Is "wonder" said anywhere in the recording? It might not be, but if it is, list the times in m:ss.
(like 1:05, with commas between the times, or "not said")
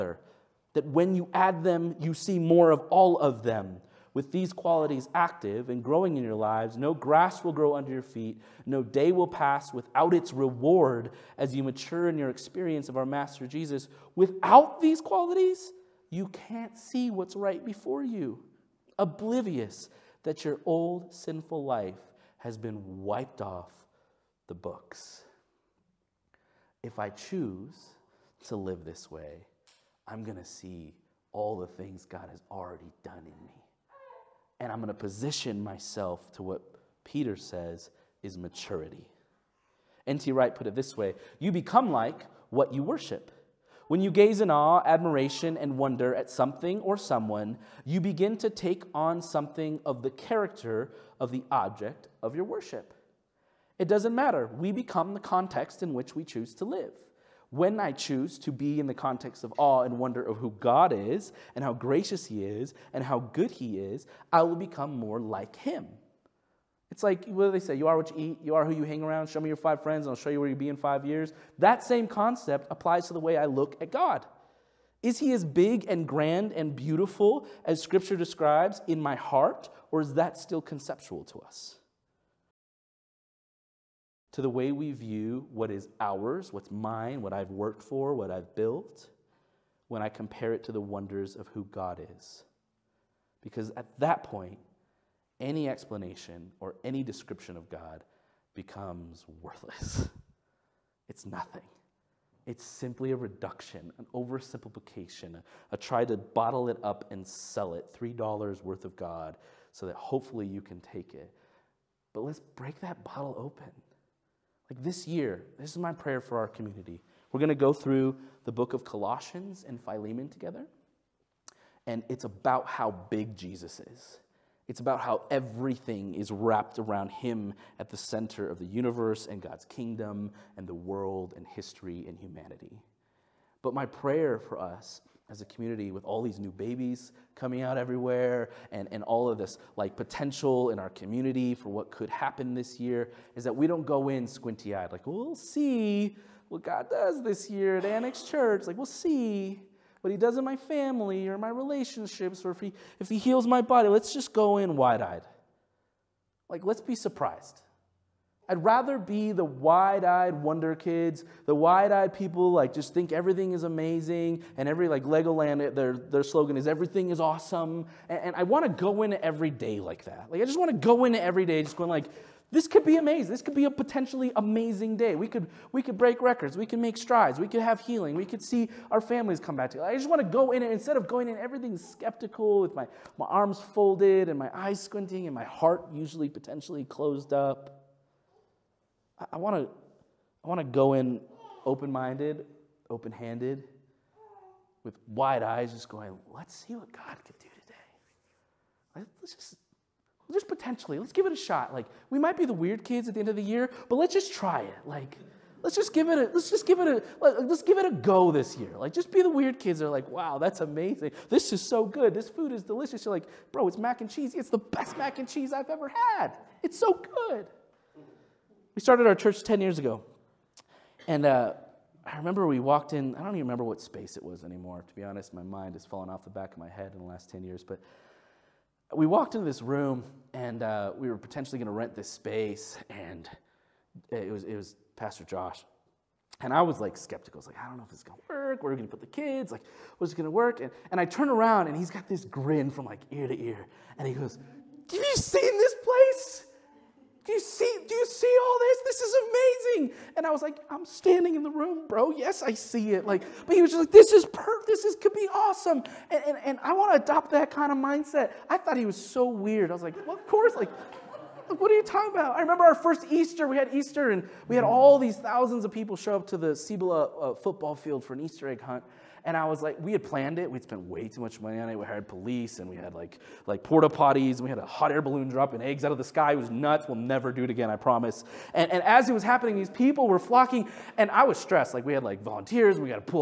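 0:45, 0:59, 1:30, 2:40.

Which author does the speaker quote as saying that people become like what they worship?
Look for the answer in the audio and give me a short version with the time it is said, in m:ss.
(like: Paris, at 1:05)
N.T. Wright, at 0:40.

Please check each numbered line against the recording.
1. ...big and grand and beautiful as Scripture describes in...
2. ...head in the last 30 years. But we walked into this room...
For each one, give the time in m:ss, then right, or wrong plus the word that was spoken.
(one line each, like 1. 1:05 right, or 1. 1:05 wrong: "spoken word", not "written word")
1. 1:15 right
2. 3:46 wrong: "10", not "30".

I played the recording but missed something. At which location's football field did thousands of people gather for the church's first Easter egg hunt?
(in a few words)
Cibola.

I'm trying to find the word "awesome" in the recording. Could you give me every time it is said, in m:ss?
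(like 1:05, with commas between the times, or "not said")
2:47, 4:15.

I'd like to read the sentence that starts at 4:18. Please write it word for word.
I thought he was so weird.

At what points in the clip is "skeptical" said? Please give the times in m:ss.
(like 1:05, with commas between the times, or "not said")
3:01, 3:56.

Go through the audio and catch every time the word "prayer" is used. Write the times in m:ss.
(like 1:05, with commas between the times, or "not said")
1:55, 2:13.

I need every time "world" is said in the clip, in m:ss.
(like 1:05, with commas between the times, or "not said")
2:10.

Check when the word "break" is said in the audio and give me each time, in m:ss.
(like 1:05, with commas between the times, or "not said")
1:52, 2:55.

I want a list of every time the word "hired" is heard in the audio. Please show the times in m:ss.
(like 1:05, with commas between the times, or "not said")
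4:31.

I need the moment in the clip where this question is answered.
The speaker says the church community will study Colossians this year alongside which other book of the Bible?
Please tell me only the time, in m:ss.
1:59.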